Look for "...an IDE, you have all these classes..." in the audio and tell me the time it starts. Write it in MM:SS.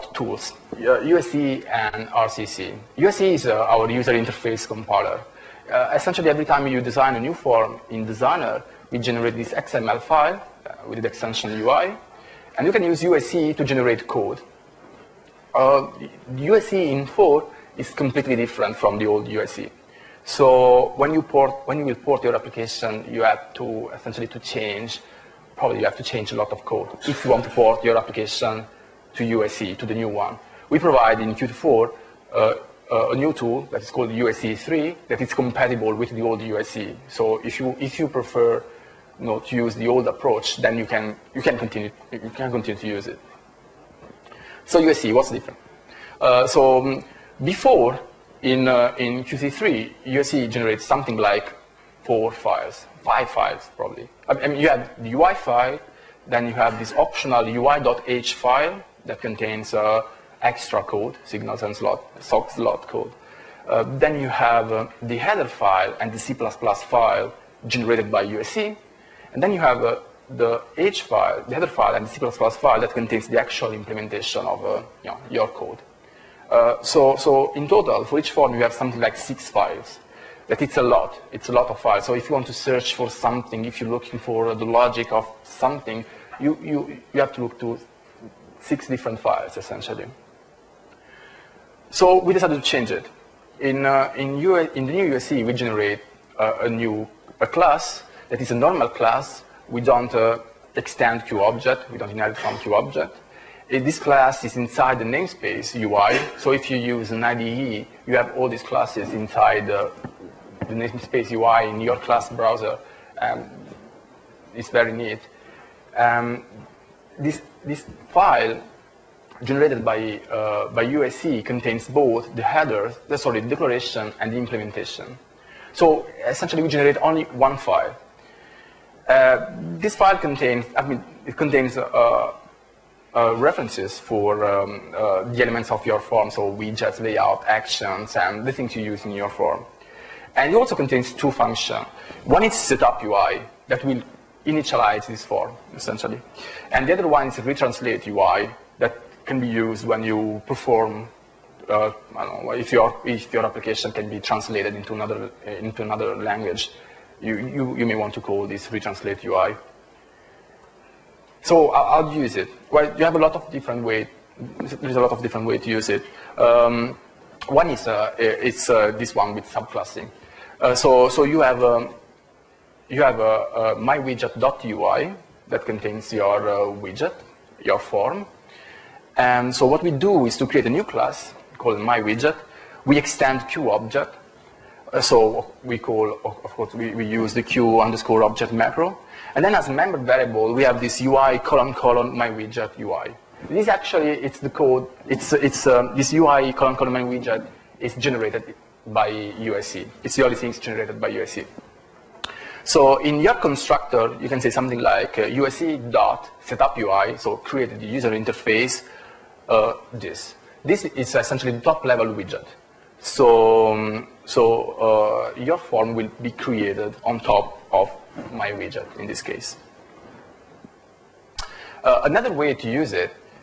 01:47.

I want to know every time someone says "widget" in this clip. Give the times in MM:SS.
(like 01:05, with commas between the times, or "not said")
02:16, 02:56, 03:01, 03:12, 03:17, 03:32, 03:38.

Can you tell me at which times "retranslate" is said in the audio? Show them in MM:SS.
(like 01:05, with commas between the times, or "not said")
02:27, 02:38.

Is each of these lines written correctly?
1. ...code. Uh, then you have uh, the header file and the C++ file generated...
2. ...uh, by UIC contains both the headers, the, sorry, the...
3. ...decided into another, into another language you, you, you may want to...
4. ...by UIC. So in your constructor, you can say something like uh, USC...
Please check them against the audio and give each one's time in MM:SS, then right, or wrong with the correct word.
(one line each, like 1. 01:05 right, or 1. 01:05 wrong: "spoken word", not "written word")
1. 01:02 right
2. 02:00 right
3. 02:34 wrong: "translated", not "decided"
4. 03:20 right.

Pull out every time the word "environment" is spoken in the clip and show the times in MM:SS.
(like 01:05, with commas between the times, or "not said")
not said.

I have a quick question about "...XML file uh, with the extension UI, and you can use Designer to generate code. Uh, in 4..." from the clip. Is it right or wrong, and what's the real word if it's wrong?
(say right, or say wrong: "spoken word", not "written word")
wrong: "UIC", not "Designer".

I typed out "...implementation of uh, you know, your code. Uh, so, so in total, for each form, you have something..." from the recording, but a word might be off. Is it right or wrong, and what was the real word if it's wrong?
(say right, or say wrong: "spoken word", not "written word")
right.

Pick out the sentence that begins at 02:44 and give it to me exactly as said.
There's a lot of different ways to use it.